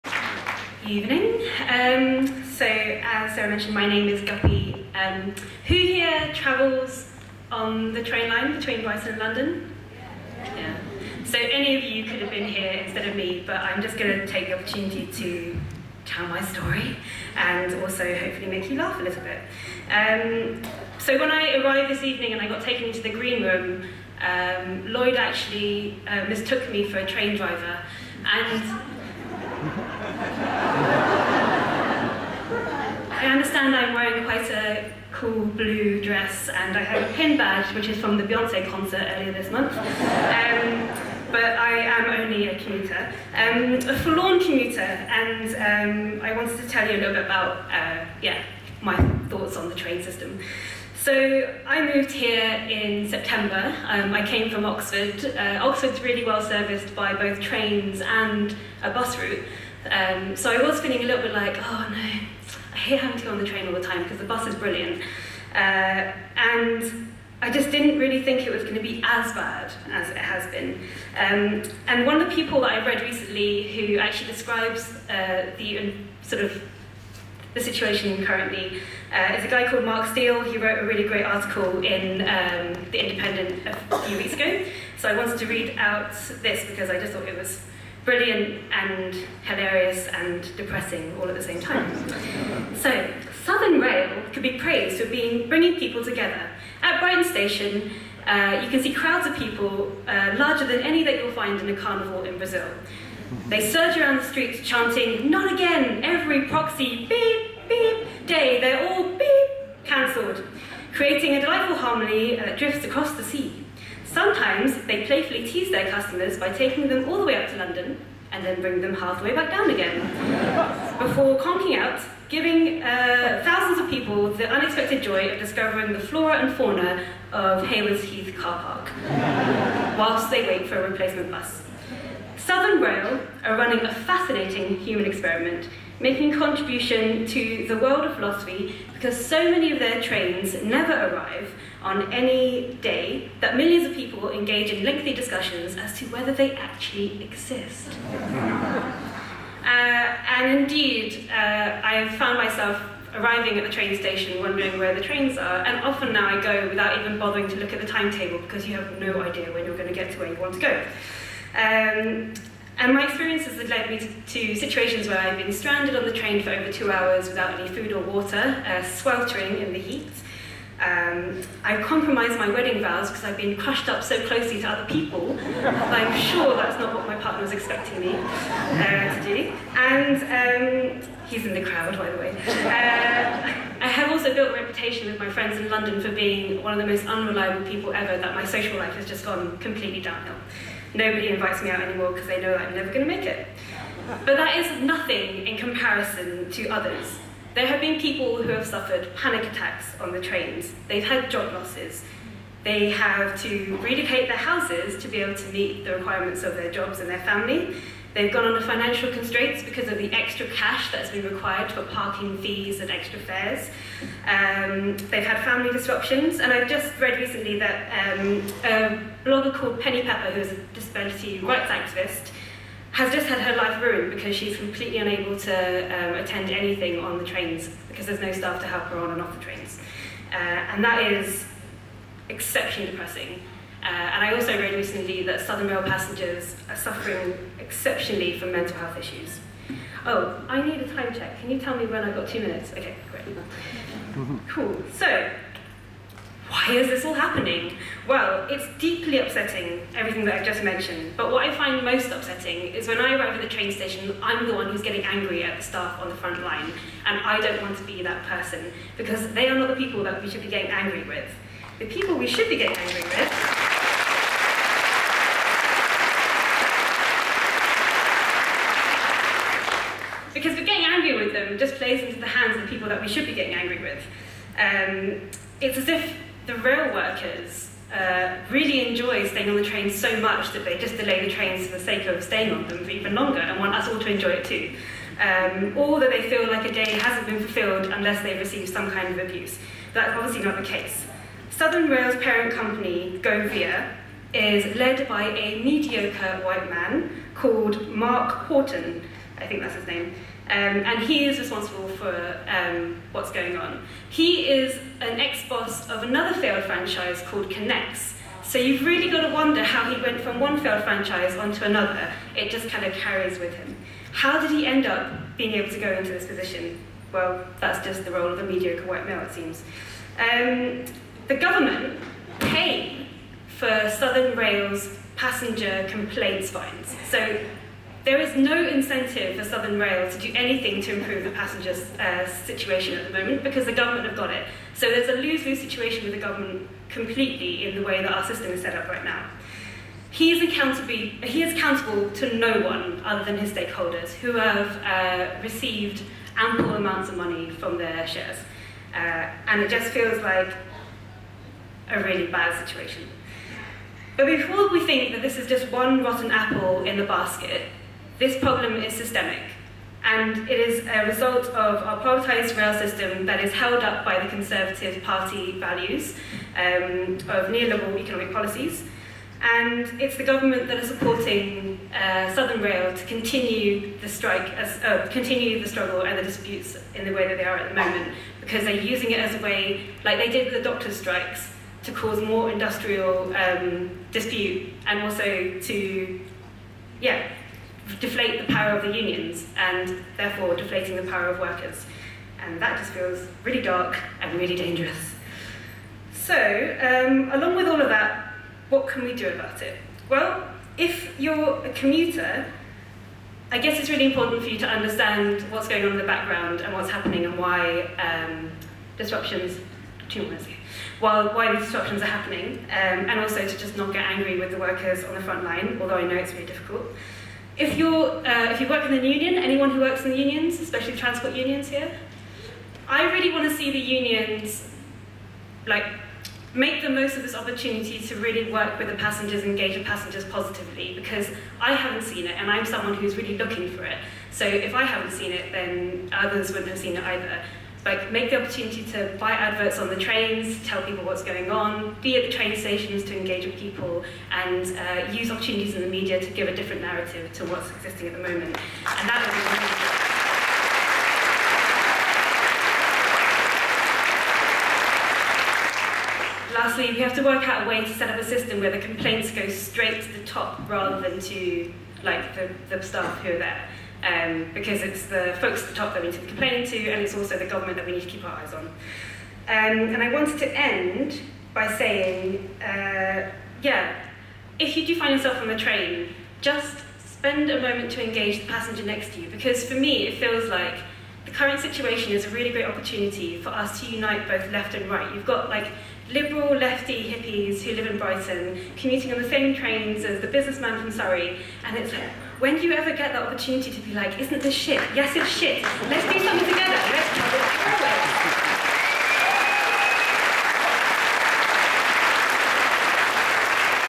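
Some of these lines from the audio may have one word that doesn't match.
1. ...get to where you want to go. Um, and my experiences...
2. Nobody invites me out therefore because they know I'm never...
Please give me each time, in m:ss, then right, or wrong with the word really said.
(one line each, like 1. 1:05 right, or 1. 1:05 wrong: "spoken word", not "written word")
1. 2:39 right
2. 3:10 wrong: "anymore", not "therefore".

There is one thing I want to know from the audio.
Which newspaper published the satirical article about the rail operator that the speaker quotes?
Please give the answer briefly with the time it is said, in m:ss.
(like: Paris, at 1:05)
The Independent, at 1:22.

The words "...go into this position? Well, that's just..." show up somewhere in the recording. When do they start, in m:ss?
5:15.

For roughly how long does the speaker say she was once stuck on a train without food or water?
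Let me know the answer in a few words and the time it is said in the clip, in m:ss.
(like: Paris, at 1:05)
Over two hours, at 2:46.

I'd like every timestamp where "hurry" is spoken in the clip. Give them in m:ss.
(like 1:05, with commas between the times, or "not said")
not said.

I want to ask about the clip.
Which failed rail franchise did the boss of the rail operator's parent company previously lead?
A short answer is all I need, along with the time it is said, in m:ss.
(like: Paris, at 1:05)
Connex, at 5:07.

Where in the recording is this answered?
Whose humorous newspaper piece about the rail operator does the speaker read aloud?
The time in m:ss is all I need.
1:19.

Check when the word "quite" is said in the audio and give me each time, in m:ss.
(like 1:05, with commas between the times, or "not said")
0:34.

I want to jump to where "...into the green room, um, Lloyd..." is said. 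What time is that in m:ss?
0:22.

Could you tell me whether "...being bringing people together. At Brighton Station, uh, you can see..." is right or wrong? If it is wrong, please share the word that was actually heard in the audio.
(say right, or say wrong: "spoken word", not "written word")
right.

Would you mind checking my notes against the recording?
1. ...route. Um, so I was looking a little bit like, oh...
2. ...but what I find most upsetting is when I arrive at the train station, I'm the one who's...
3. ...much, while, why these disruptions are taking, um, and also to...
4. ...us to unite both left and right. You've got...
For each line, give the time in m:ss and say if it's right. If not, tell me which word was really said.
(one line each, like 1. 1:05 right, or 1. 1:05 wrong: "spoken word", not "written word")
1. 0:59 wrong: "feeling", not "looking"
2. 4:11 right
3. 6:50 wrong: "happening", not "taking"
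4. 8:03 right.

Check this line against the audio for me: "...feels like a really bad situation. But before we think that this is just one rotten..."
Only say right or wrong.
right.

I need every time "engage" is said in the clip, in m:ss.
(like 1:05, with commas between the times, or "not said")
2:24, 7:09, 7:23, 7:58.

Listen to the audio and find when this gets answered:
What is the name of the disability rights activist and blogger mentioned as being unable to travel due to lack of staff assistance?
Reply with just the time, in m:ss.
3:39.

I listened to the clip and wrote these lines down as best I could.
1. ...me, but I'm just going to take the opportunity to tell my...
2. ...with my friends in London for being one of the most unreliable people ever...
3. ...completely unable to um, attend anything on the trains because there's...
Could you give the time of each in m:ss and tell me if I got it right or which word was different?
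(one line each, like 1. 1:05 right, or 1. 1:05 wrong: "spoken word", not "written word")
1. 0:13 right
2. 3:05 right
3. 3:44 right.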